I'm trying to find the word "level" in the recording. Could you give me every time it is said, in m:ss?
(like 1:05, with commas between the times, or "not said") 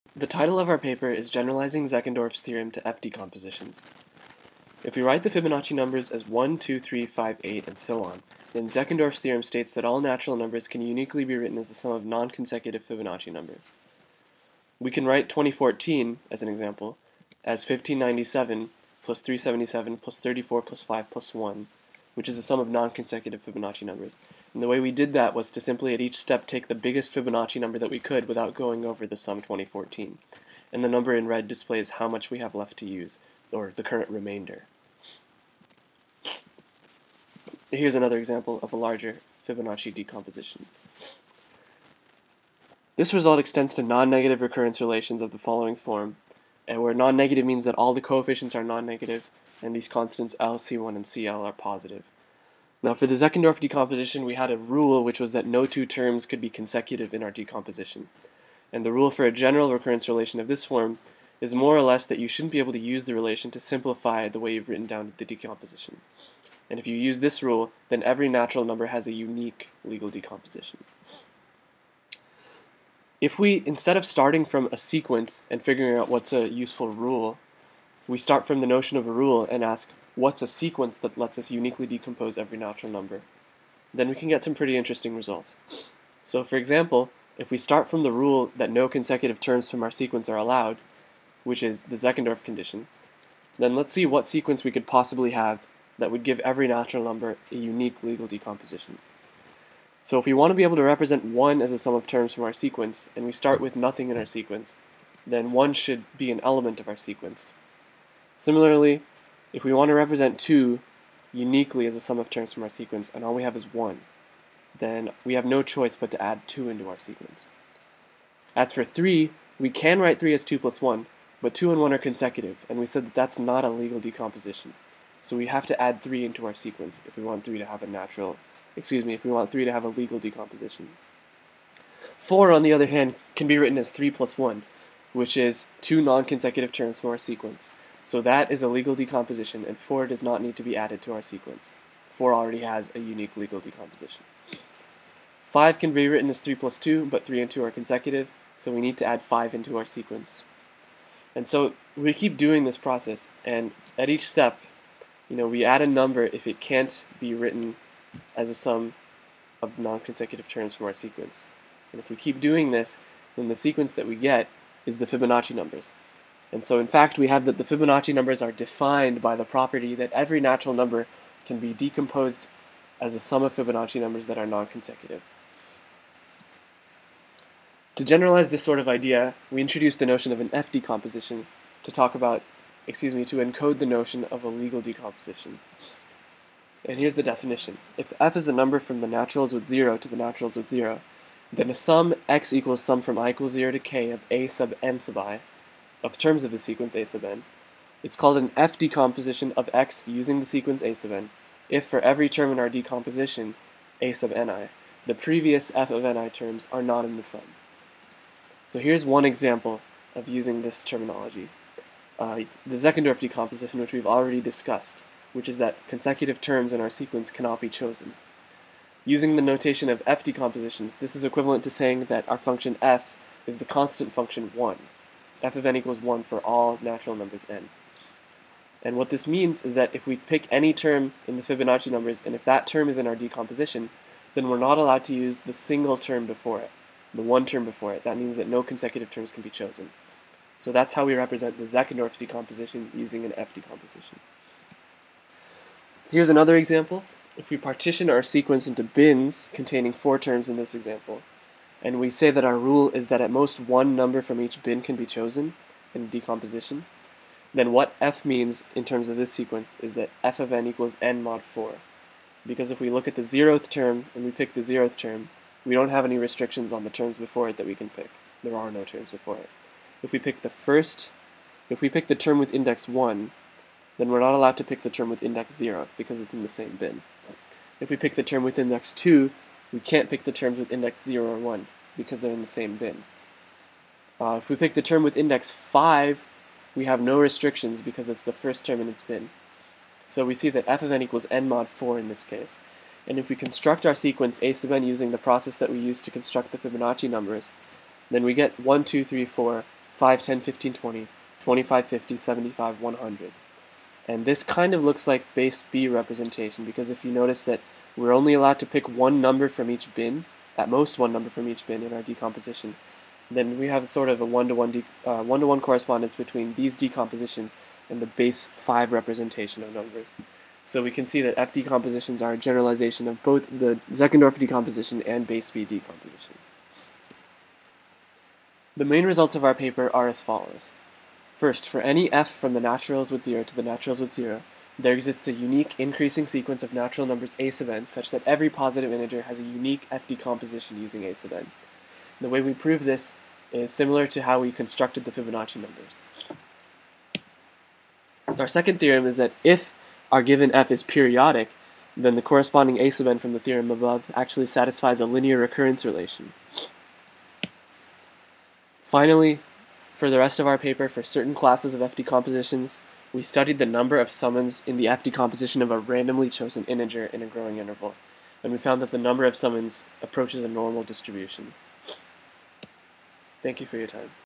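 not said.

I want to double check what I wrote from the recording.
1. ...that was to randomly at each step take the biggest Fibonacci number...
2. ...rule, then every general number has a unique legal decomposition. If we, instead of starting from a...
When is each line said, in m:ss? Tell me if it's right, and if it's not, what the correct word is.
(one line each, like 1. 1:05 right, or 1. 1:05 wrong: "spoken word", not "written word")
1. 0:25 wrong: "simply", not "randomly"
2. 1:07 wrong: "natural", not "general".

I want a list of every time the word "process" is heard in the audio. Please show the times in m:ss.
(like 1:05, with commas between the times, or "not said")
2:32, 4:55.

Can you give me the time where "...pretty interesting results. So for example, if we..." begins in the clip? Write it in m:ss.
1:24.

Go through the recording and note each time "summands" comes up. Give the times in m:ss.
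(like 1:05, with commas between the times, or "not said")
6:04, 6:09.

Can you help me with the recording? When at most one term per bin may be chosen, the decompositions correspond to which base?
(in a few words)
5.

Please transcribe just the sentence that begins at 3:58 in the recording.
That means that no consecutive terms can be chosen.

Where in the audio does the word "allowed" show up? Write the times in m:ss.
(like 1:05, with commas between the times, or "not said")
1:30, 3:54, 4:34, 5:08.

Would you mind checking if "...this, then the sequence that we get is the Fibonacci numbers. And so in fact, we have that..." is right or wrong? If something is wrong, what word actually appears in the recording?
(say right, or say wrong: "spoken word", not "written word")
right.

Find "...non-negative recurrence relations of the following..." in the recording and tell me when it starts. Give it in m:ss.
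0:43.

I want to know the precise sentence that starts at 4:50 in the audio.
So we see that f of n equals n mod 4 in this case.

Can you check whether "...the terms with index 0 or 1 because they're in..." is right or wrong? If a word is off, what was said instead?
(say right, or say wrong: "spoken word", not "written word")
right.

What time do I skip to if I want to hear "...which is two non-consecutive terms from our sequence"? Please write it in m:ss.
2:15.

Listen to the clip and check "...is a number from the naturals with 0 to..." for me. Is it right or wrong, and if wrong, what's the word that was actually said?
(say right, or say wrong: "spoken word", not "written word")
right.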